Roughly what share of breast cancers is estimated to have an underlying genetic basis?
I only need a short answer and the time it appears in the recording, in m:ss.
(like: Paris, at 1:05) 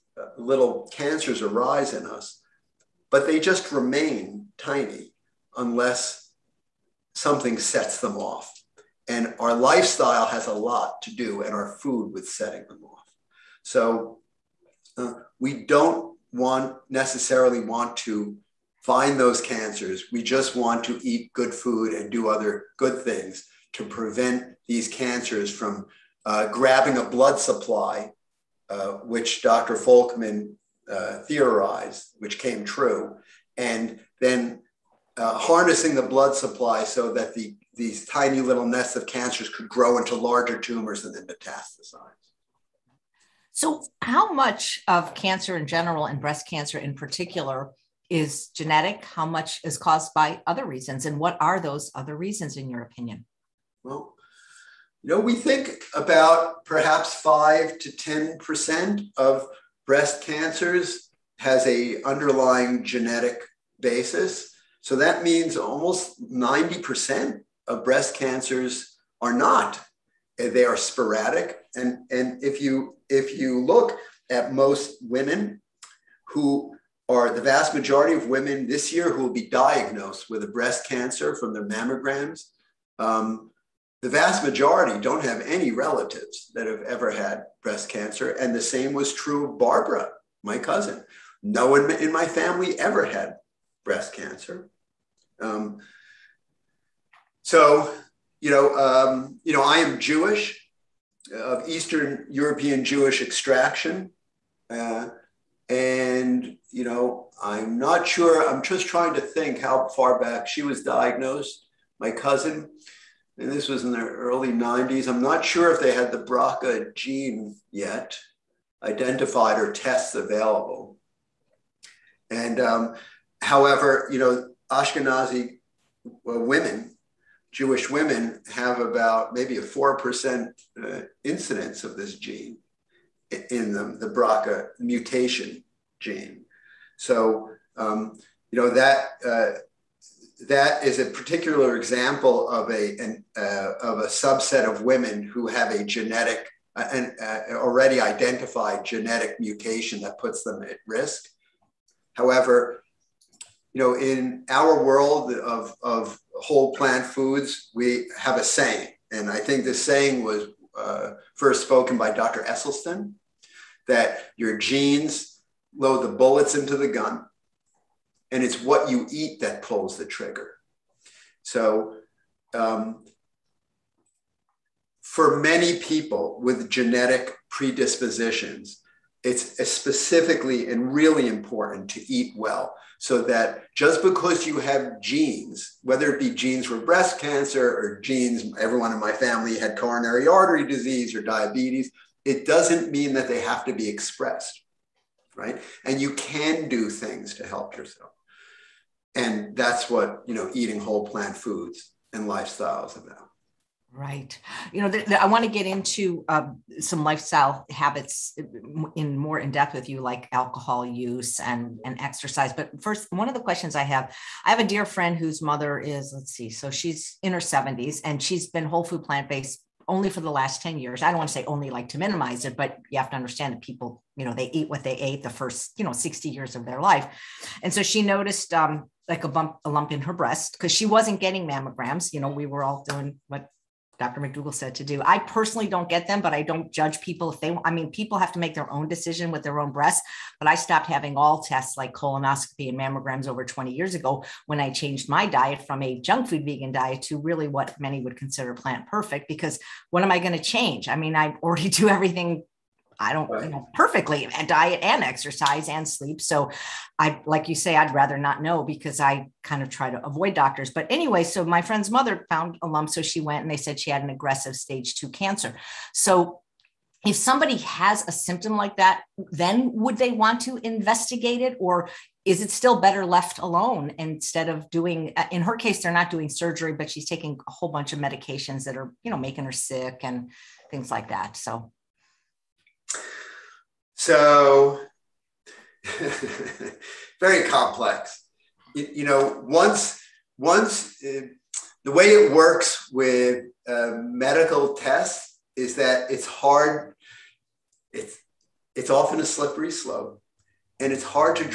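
5 to 10%, at 0:57.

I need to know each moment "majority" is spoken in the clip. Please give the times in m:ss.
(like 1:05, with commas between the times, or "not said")
1:17, 1:24.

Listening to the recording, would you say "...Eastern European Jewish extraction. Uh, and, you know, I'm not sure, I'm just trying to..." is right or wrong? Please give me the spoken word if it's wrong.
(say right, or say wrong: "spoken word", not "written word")
right.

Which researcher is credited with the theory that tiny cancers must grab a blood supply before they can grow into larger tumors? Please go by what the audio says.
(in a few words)
Dr. Folkman.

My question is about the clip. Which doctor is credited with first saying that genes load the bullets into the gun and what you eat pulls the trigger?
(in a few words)
Dr. Esselstyn.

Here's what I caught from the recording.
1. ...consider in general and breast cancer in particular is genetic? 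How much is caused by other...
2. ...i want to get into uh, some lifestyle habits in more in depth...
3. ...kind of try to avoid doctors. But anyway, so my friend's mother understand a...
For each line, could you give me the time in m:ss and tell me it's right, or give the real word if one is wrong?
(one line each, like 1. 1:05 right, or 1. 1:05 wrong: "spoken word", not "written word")
1. 0:45 wrong: "cancer", not "consider"
2. 3:25 right
3. 4:19 wrong: "found", not "understand".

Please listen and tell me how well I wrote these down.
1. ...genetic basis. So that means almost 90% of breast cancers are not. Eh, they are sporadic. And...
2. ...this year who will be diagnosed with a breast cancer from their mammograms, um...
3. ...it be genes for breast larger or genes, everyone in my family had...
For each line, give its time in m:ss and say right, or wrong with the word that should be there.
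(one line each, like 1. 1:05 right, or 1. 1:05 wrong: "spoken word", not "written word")
1. 1:02 right
2. 1:18 right
3. 3:06 wrong: "cancer", not "larger".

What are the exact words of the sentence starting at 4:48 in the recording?
You, you, know, once once uh, the way it works with uh, medical tests is that it's hard.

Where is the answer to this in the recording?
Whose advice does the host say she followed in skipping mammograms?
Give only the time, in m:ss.
3:53.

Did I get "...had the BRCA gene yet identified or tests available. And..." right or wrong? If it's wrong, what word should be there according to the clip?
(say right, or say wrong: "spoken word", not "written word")
right.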